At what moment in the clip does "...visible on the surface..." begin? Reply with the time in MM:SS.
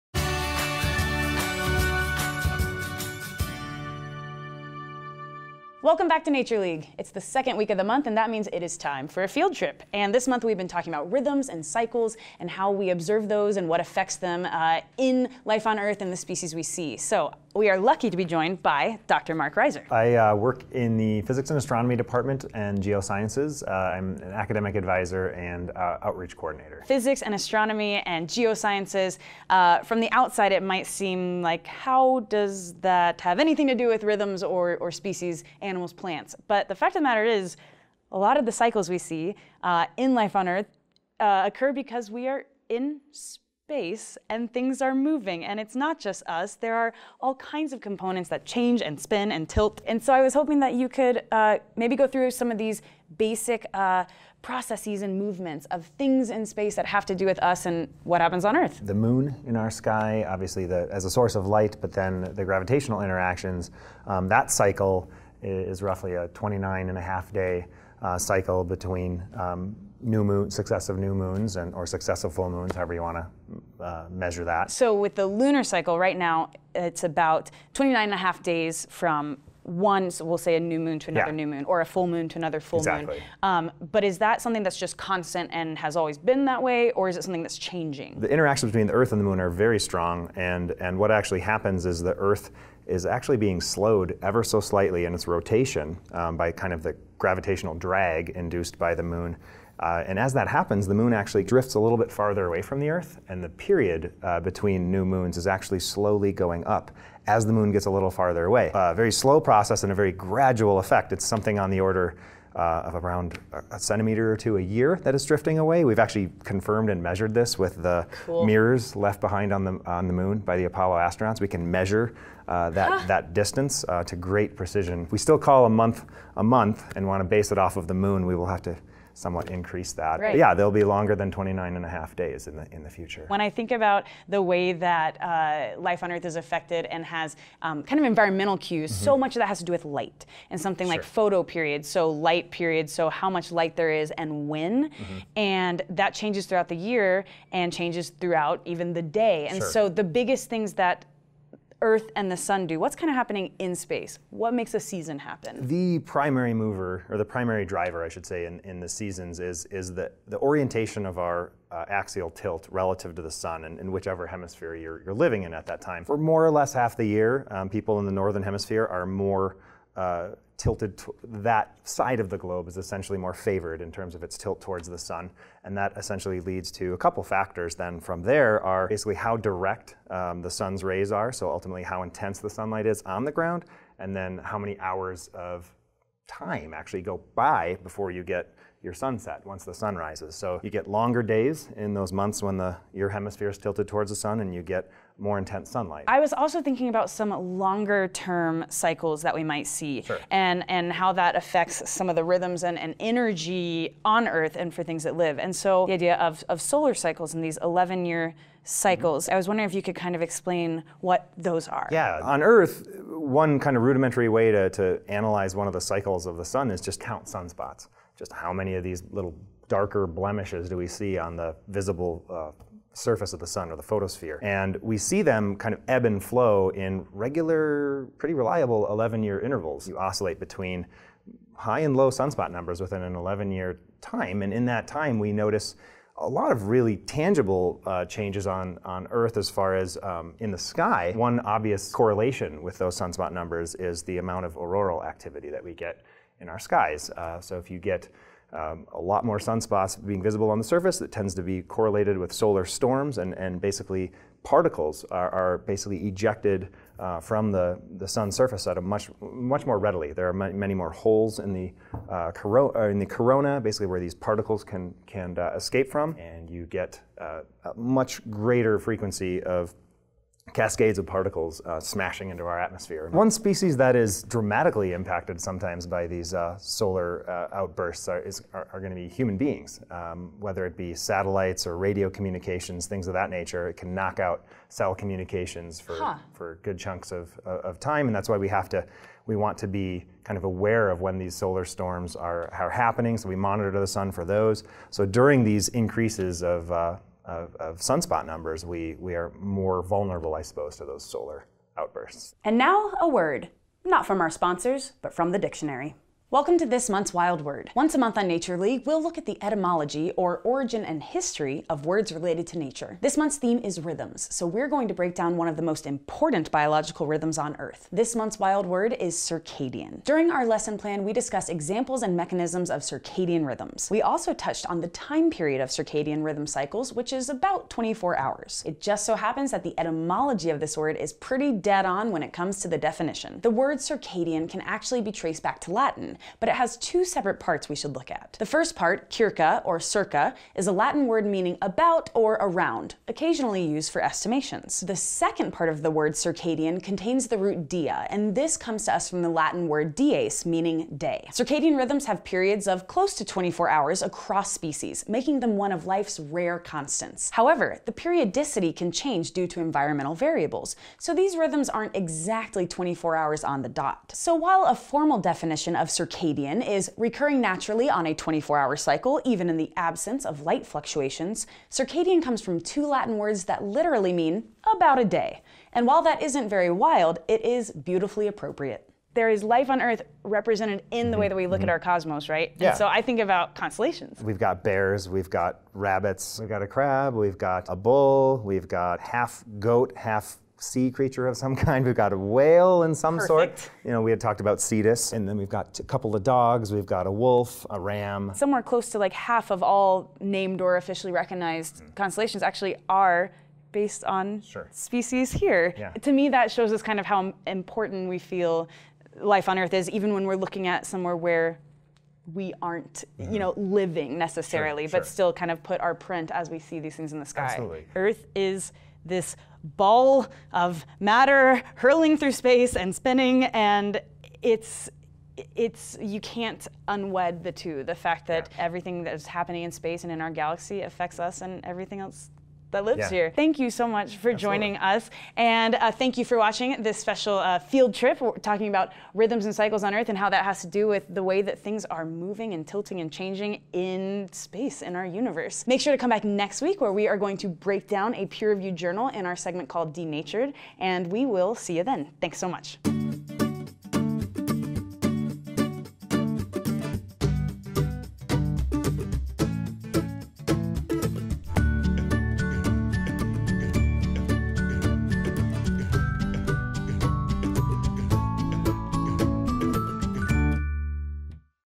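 04:10.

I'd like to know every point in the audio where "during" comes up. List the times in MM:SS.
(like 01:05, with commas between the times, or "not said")
04:55, 05:20.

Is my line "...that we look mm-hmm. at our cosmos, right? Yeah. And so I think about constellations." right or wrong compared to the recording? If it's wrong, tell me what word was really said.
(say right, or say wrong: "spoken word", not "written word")
right.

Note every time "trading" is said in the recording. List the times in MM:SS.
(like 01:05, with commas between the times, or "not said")
not said.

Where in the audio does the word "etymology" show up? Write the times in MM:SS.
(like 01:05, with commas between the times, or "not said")
05:09, 05:29.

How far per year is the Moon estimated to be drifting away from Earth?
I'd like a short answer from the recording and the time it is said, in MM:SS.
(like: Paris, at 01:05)
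1 or 2 centimeters, at 01:53.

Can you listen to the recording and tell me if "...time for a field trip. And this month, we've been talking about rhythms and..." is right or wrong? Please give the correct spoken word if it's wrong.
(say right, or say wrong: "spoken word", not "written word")
right.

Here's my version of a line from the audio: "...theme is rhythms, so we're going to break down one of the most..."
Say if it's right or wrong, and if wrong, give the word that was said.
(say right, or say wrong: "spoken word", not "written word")
right.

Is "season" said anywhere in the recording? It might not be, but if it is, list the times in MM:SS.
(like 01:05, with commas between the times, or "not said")
02:34, 02:38.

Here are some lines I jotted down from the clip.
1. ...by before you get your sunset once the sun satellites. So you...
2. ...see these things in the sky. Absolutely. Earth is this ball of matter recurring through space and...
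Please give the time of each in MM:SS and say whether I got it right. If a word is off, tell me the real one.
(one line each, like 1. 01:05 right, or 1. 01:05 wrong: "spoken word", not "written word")
1. 03:07 wrong: "rises", not "satellites"
2. 06:56 wrong: "hurling", not "recurring".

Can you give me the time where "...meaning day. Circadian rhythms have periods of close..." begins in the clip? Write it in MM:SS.
05:50.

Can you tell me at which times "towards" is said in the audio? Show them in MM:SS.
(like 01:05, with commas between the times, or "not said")
02:54, 03:13.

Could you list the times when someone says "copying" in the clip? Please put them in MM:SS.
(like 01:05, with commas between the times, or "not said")
not said.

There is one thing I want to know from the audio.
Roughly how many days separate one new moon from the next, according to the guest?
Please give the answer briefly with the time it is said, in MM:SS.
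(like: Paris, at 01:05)
29 and a half days, at 01:06.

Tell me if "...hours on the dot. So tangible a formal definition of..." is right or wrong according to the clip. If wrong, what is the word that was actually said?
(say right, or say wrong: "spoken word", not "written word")
wrong: "while", not "tangible".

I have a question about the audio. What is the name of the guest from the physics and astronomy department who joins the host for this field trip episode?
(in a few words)
Mark Reiser.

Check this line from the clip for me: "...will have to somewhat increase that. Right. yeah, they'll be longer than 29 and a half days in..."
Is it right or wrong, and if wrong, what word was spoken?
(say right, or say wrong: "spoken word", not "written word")
right.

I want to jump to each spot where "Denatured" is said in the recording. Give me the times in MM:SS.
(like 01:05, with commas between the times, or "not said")
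07:29.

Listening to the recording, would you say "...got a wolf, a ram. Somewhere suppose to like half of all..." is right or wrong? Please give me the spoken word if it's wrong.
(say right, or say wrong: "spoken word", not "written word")
wrong: "close", not "suppose".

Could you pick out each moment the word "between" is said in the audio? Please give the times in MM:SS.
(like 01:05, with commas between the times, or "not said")
01:08, 01:28, 01:44, 03:50.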